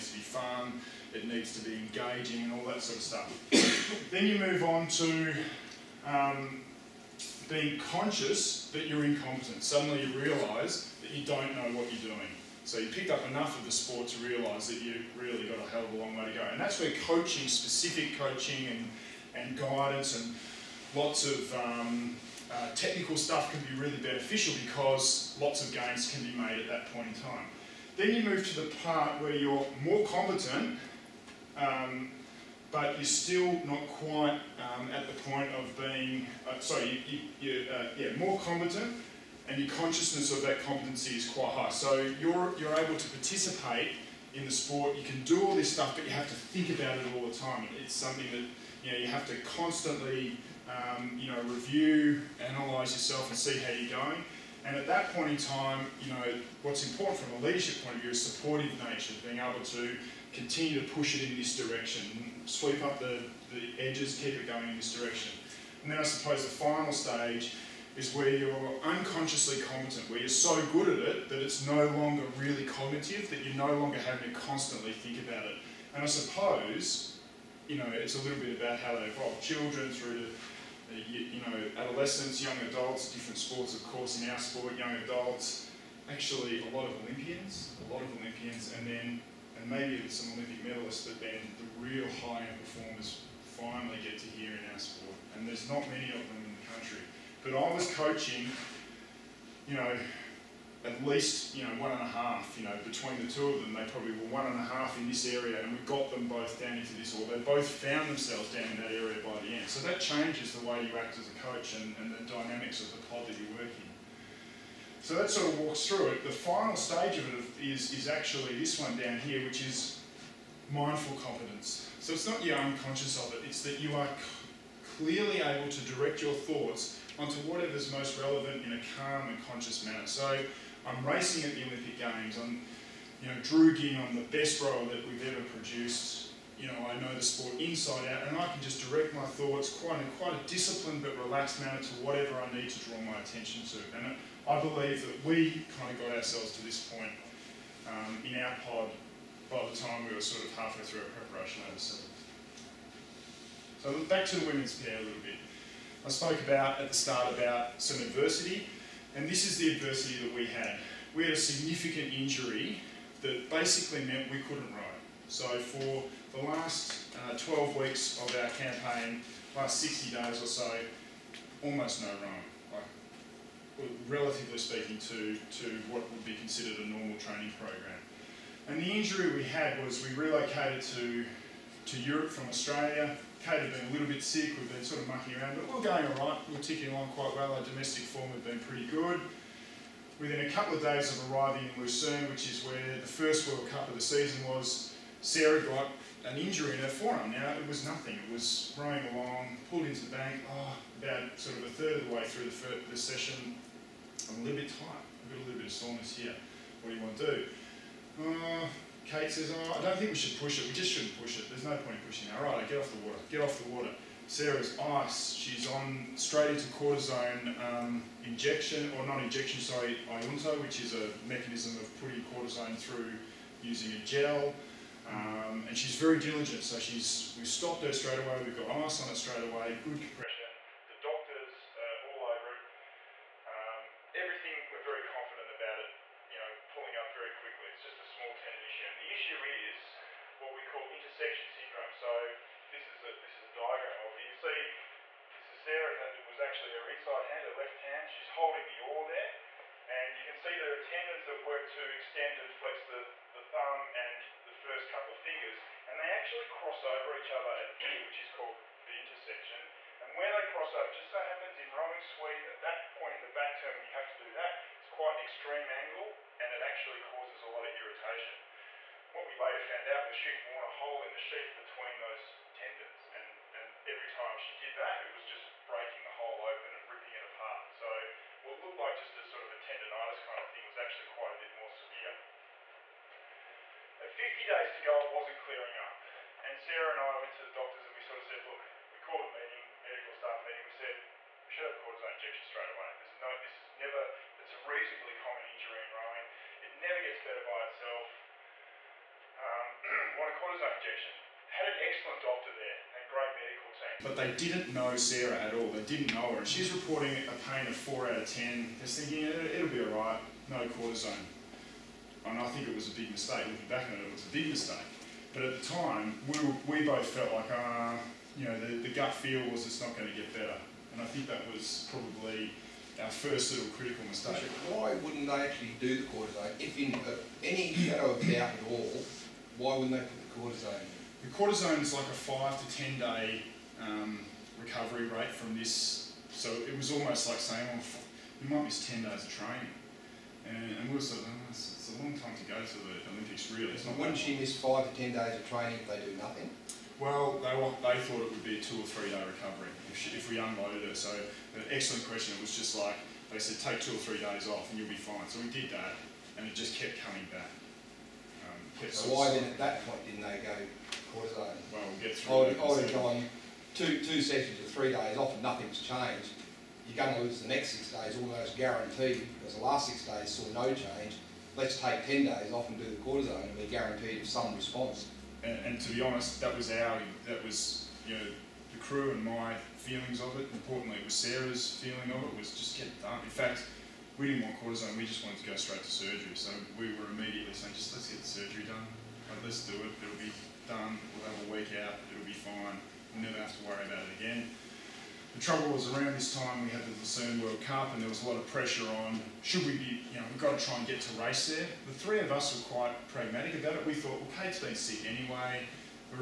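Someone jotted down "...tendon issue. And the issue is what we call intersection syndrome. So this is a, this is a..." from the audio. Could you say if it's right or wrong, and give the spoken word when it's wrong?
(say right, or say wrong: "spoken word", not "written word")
right.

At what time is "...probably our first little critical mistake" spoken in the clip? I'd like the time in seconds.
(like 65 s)
321 s.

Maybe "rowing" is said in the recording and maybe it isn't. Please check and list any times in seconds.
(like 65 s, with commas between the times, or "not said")
172 s, 198 s, 261 s, 295 s.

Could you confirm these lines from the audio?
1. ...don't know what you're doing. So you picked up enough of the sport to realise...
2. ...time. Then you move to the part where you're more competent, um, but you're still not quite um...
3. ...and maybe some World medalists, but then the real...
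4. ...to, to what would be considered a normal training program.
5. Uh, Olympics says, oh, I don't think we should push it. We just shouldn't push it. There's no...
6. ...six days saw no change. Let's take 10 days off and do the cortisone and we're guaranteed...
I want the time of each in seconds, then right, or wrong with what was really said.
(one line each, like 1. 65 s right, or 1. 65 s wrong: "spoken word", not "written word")
1. 11 s right
2. 27 s right
3. 89 s wrong: "Olympic", not "World"
4. 174 s right
5. 208 s wrong: "Kate", not "Olympics"
6. 369 s right.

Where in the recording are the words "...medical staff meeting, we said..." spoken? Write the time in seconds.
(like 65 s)
289 s.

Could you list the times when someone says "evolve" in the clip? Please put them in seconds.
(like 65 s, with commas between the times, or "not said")
79 s.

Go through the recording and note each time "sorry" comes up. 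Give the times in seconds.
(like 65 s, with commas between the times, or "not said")
36 s, 219 s.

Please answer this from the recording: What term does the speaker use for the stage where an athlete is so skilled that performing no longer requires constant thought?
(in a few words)
Unconsciously competent.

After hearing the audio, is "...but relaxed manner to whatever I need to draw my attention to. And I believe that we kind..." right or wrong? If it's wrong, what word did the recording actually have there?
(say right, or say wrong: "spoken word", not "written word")
right.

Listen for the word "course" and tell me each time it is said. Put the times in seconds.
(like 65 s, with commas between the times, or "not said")
83 s.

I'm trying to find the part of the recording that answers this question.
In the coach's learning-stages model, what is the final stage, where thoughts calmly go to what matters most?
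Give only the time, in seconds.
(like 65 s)
120 s.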